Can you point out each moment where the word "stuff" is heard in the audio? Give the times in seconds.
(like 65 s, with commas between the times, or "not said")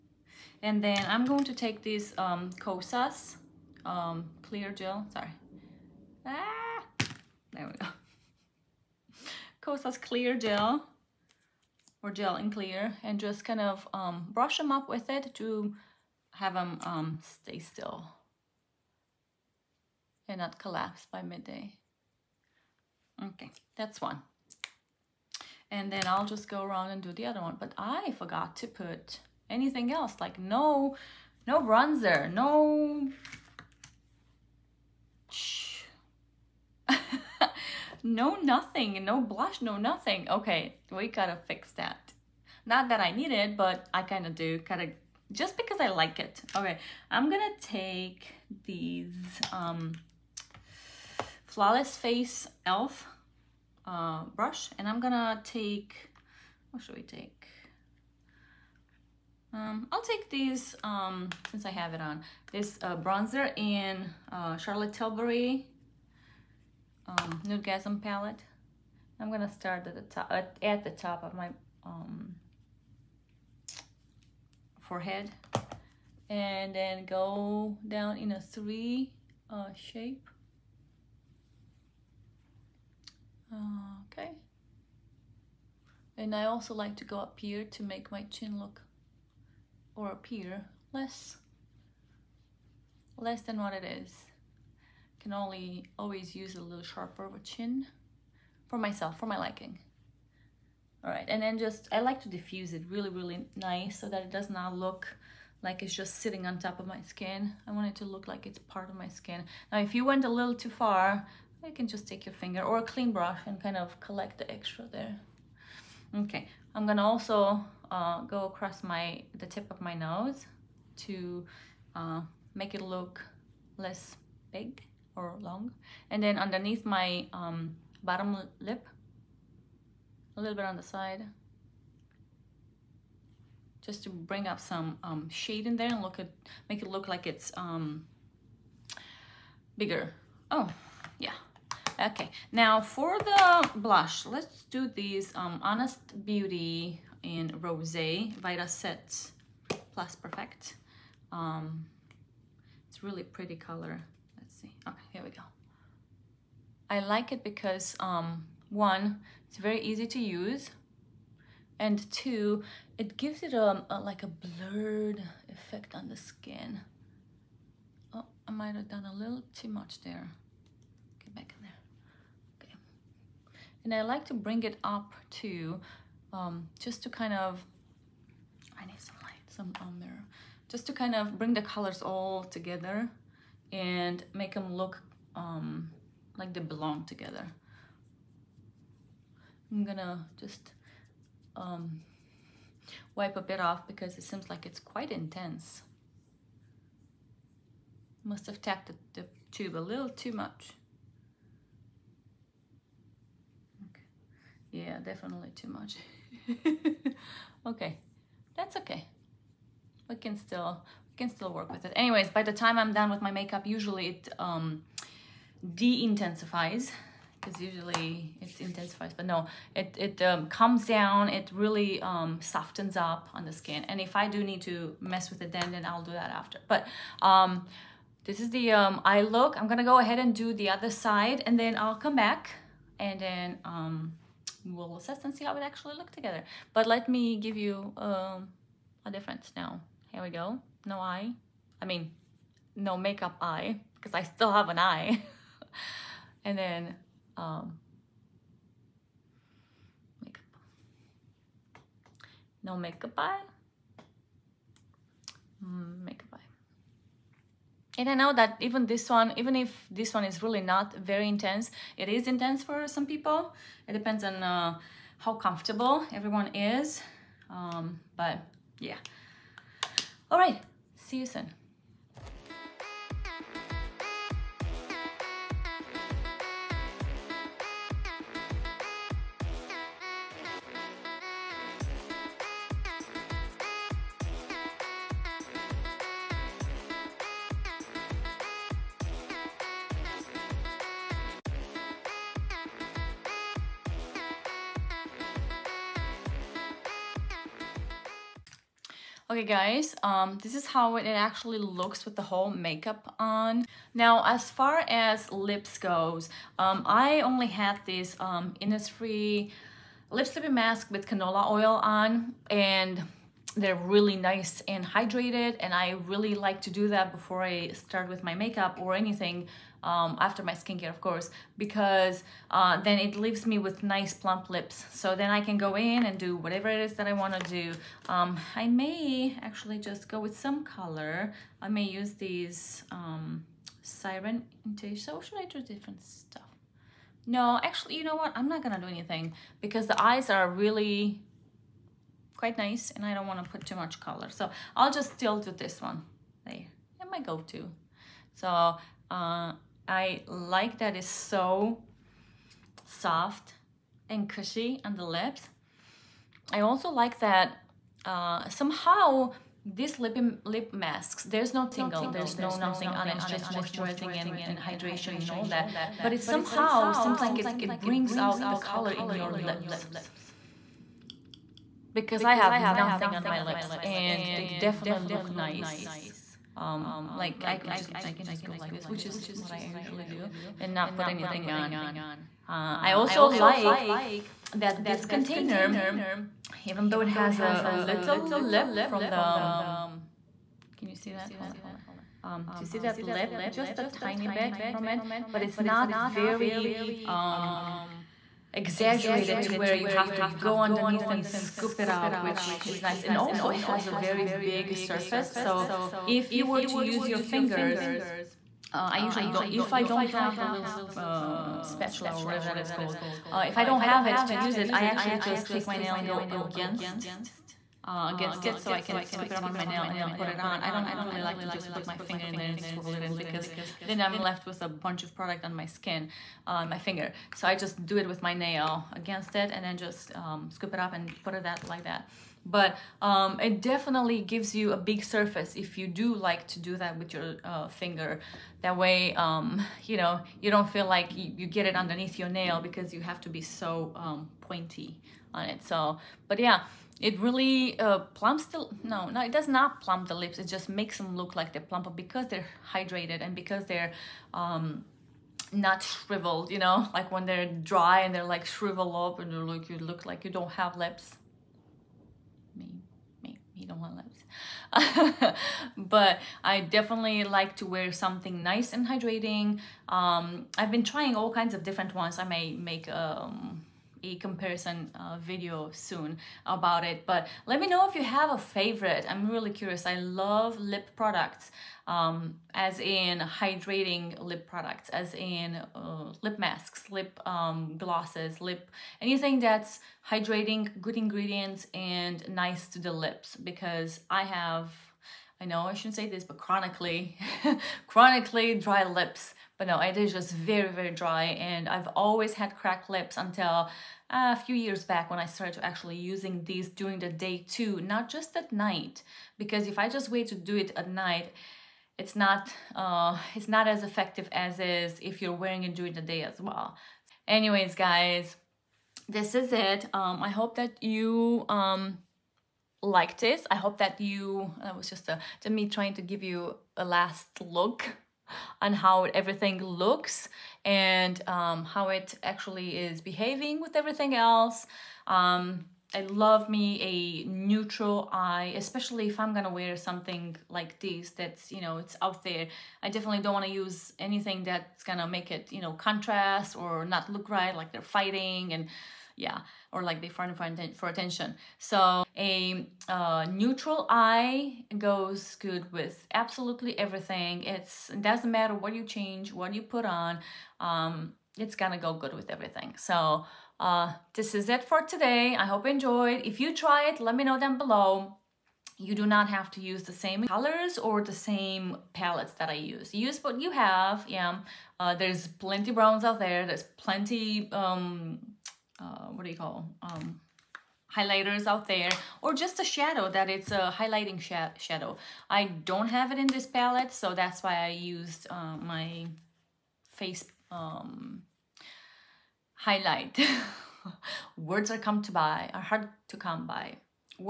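336 s.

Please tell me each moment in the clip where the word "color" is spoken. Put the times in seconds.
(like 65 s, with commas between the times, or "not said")
153 s, 181 s, 330 s, 343 s, 368 s, 570 s.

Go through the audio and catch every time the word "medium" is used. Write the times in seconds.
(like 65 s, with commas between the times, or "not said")
not said.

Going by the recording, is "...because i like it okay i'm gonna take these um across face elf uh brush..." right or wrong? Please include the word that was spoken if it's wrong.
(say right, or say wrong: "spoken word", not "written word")
wrong: "flawless", not "across".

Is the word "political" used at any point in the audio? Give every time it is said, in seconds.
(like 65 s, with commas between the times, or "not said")
not said.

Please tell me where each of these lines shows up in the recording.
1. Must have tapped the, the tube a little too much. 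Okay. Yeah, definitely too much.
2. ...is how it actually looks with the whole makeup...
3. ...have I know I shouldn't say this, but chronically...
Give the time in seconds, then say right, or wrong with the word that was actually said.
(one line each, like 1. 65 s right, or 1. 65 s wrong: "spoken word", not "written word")
1. 198 s right
2. 300 s right
3. 494 s right.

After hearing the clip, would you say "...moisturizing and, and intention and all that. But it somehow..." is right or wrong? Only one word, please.
wrong.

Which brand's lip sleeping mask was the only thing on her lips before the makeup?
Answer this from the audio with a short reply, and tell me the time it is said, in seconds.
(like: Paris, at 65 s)
Innisfree, at 308 s.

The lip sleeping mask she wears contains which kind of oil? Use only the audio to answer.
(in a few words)
Canola oil.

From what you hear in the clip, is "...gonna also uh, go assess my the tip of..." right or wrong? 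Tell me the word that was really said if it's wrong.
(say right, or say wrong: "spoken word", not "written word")
wrong: "across", not "assess".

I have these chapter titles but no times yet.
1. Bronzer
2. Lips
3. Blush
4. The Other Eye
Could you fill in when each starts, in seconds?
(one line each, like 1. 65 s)
1. 27 s
2. 304 s
3. 142 s
4. 229 s.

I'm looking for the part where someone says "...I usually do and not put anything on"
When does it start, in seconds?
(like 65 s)
379 s.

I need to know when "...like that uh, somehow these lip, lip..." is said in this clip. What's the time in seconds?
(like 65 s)
356 s.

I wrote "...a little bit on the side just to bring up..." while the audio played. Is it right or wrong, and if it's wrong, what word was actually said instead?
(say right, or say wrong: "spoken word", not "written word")
right.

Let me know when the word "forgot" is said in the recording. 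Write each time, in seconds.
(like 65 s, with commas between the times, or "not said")
28 s.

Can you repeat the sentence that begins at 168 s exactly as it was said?
Oh, I might have done a little too much there.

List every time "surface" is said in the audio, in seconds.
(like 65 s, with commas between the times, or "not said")
404 s, 435 s.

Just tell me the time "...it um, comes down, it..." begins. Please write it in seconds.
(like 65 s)
219 s.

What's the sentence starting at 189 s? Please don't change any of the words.
I'm gonna just um, wipe a bit off because it seems like it's quite intense.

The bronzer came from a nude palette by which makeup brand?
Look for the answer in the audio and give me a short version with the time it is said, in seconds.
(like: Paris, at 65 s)
Charlotte Tilbury, at 64 s.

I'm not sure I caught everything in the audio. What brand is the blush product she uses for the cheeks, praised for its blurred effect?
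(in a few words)
Honest Beauty.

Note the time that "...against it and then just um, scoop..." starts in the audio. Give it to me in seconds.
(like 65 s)
428 s.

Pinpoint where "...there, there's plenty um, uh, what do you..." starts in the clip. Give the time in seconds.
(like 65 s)
576 s.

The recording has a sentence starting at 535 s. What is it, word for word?
Um, I love me a neutral eye, especially if I'm gonna wear something like this that's, you know, it's out there.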